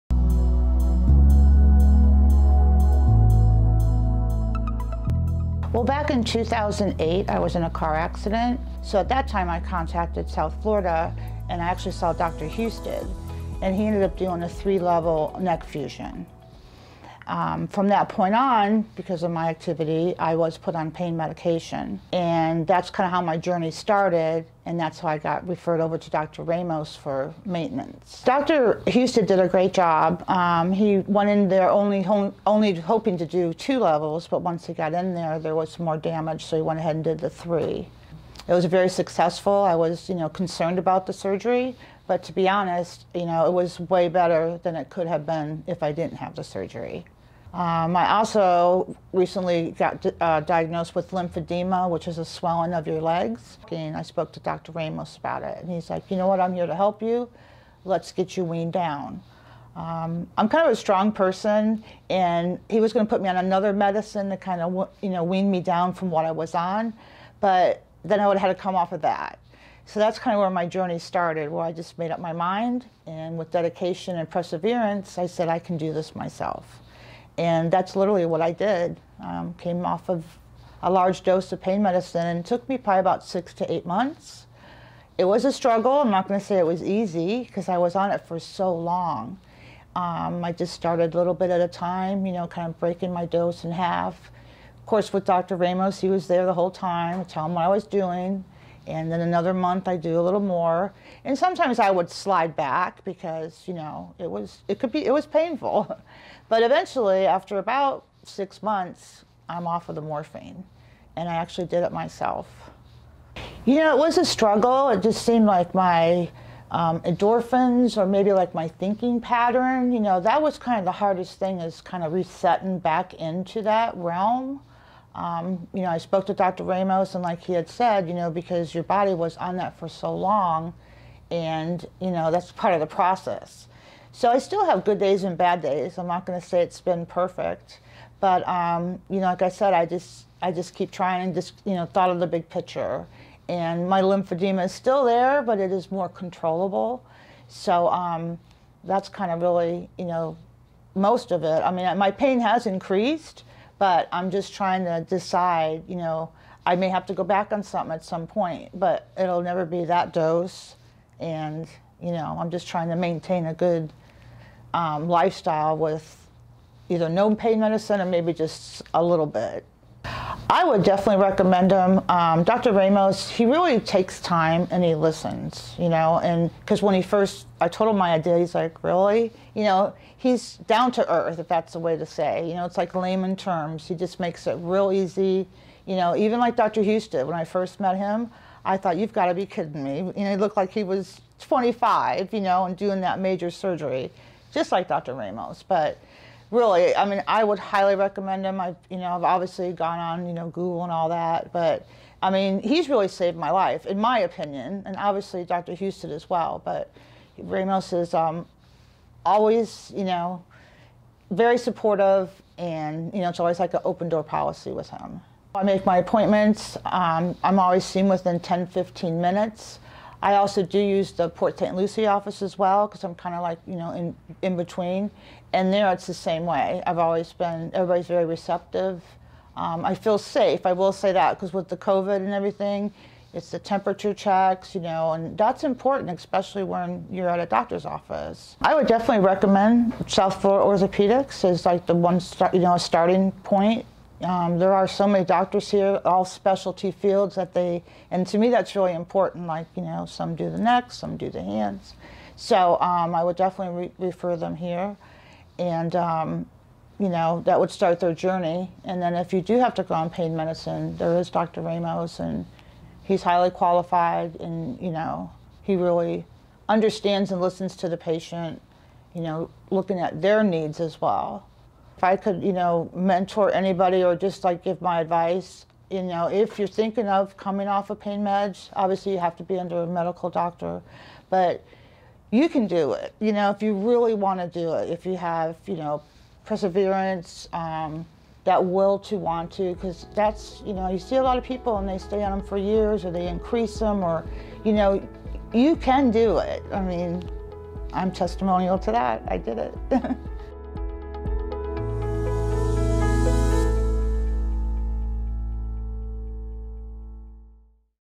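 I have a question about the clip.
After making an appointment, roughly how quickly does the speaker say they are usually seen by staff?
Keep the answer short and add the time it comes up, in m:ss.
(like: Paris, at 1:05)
10 to 15 minutes, at 3:38.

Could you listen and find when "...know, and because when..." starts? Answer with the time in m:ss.
2:55.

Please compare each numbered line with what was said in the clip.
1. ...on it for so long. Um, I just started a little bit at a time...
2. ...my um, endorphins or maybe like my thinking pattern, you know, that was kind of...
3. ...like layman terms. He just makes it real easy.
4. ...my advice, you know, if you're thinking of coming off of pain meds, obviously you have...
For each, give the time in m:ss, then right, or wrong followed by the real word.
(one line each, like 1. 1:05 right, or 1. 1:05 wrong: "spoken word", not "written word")
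1. 1:27 right
2. 1:55 right
3. 3:02 right
4. 4:34 right.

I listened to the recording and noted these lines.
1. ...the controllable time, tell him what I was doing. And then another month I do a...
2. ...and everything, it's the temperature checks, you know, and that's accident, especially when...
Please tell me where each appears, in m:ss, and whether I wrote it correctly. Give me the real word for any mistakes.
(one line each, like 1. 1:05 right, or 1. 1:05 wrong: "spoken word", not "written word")
1. 1:36 wrong: "whole", not "controllable"
2. 3:52 wrong: "important", not "accident".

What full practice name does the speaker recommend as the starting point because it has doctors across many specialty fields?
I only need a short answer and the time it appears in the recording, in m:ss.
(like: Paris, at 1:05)
South Florida Orthopaedics, at 4:00.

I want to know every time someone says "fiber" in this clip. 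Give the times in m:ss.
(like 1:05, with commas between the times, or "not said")
not said.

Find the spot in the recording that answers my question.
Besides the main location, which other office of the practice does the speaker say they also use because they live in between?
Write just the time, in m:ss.
3:41.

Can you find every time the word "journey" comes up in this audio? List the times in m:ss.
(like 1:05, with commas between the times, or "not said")
0:23, 1:10, 4:18.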